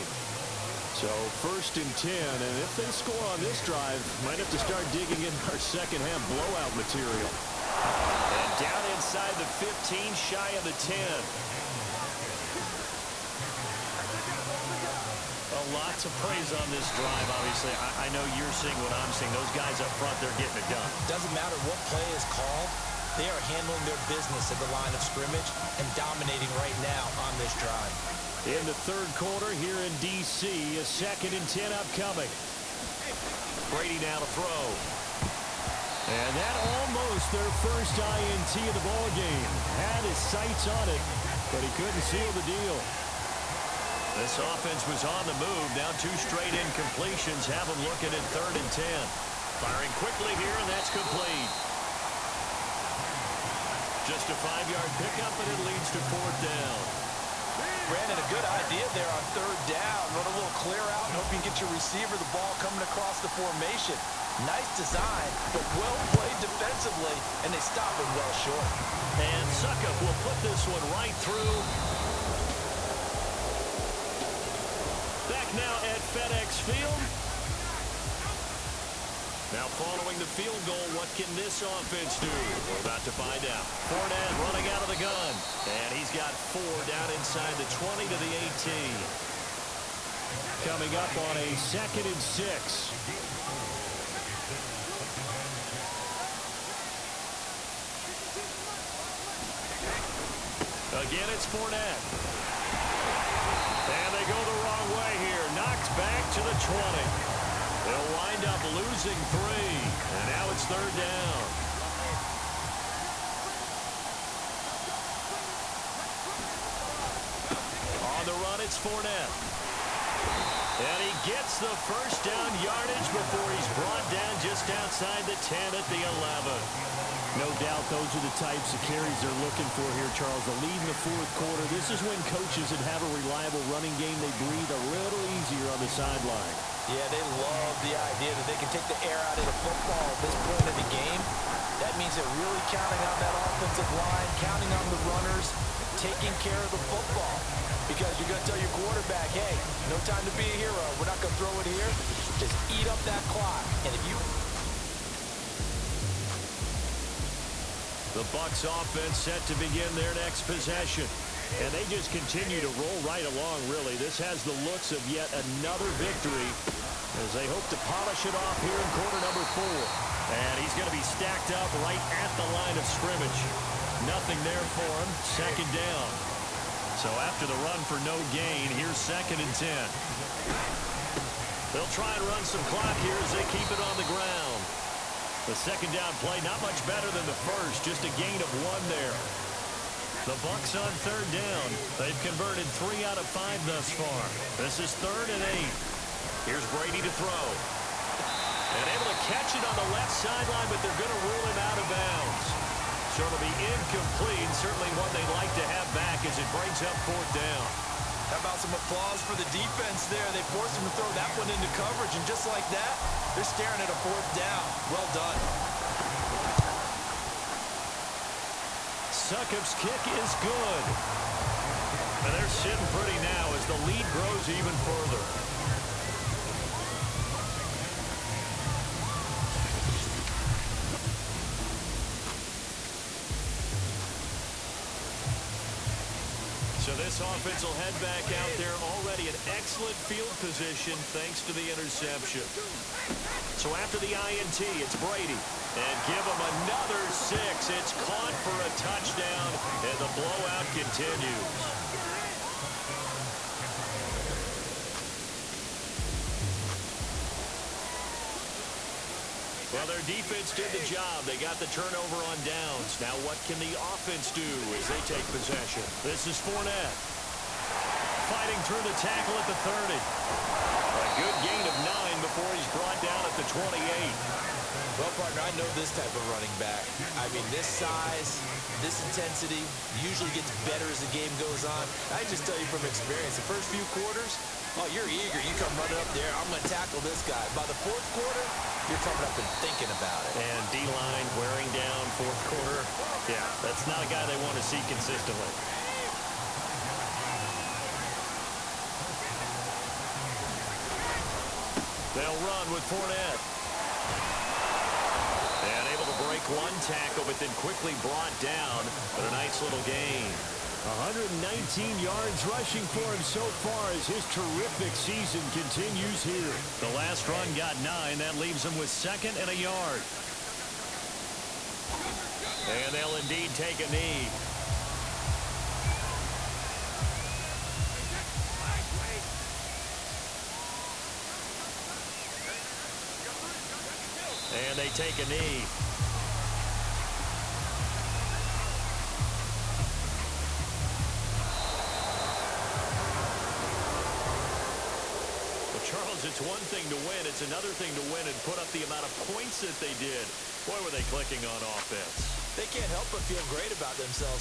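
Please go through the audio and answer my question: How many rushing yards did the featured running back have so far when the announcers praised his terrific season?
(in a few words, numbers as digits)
119.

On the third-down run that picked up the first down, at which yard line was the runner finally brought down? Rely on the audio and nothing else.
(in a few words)
11.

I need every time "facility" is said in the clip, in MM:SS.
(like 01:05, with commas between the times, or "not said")
not said.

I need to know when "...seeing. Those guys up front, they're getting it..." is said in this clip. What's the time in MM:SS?
00:19.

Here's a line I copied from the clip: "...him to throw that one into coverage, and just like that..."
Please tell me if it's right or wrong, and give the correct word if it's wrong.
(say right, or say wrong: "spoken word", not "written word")
right.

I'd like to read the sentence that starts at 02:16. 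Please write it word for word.
Yeah, they love the idea that they can take the air out of the football at this point of the game.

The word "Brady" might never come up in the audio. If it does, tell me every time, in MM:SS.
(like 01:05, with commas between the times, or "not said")
00:33, 03:16, 04:04.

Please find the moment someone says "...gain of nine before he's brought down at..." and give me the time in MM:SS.
04:31.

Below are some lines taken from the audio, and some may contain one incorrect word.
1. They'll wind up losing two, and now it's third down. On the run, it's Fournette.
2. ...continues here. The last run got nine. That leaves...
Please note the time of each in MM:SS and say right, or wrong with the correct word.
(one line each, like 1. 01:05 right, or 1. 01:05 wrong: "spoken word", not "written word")
1. 01:47 wrong: "three", not "two"
2. 05:15 right.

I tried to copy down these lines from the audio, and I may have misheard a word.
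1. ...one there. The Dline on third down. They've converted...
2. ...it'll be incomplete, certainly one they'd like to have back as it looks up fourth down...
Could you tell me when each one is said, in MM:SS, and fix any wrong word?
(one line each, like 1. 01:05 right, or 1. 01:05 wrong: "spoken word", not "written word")
1. 03:08 wrong: "Bucks", not "Dline"
2. 03:23 wrong: "breaks", not "looks".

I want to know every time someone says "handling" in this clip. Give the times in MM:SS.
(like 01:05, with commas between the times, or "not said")
00:23.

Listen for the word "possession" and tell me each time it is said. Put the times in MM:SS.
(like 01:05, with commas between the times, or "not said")
02:40, 04:25.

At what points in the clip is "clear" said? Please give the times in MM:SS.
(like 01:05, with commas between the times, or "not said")
01:00.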